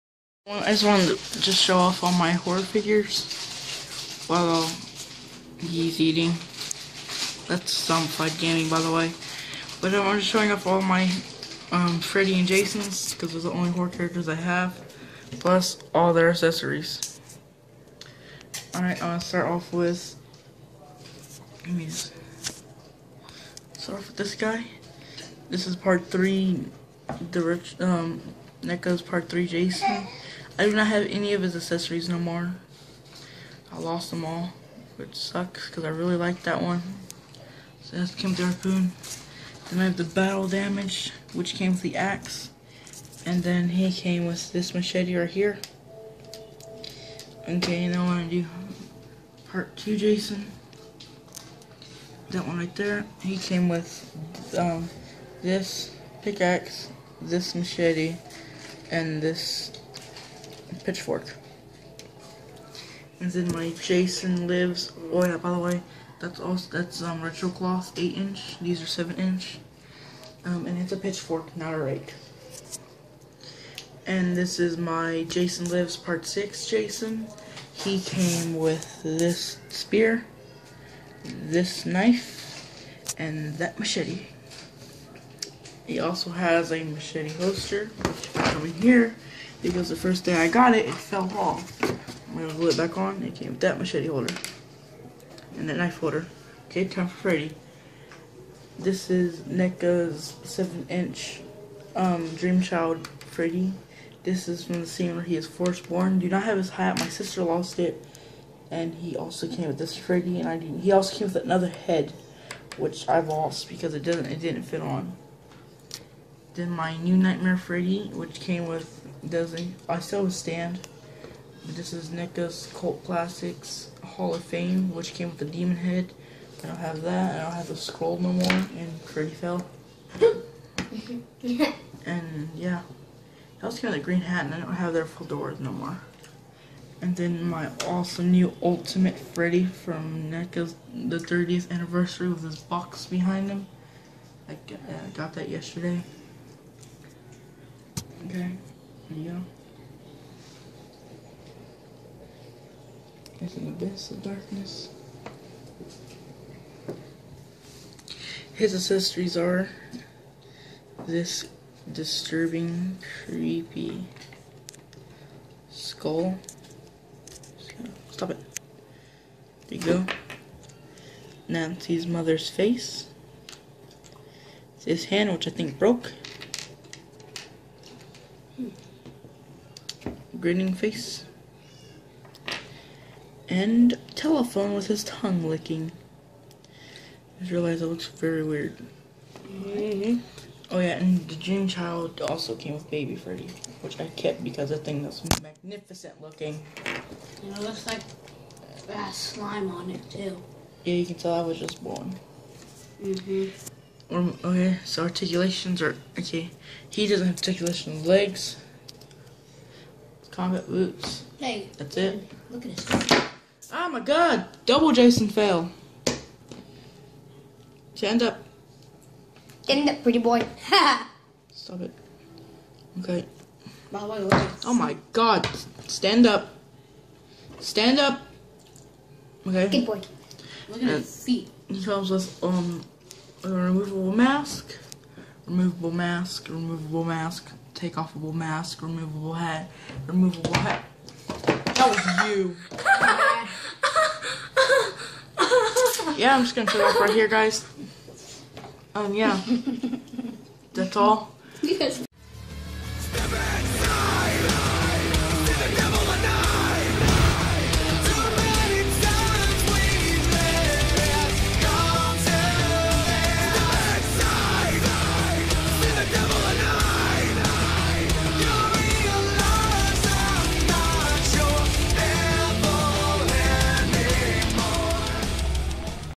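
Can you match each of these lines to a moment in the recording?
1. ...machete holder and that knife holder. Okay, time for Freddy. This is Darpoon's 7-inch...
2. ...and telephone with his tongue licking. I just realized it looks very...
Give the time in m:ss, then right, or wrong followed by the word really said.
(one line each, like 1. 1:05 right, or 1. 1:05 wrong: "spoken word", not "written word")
1. 1:33 wrong: "NECA", not "Darpoon"
2. 3:03 right.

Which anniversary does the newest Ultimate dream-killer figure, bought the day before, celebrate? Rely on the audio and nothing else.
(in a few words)
30th anniversary.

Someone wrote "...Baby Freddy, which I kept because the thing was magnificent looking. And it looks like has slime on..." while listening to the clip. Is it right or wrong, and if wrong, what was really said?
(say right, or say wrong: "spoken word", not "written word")
right.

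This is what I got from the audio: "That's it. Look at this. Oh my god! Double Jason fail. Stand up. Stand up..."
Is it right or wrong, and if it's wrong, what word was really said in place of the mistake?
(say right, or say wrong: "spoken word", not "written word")
right.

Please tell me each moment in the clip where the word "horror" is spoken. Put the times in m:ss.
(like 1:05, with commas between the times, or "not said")
0:02, 0:13.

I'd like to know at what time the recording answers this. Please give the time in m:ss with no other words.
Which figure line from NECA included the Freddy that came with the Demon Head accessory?
2:02.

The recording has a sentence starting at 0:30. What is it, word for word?
I do not have any of his accessories no more.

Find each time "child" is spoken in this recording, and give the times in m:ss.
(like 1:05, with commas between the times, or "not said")
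1:42, 3:11.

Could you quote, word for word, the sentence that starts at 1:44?
This is from the scene where he is born.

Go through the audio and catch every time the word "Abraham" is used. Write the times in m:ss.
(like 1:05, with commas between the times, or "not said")
not said.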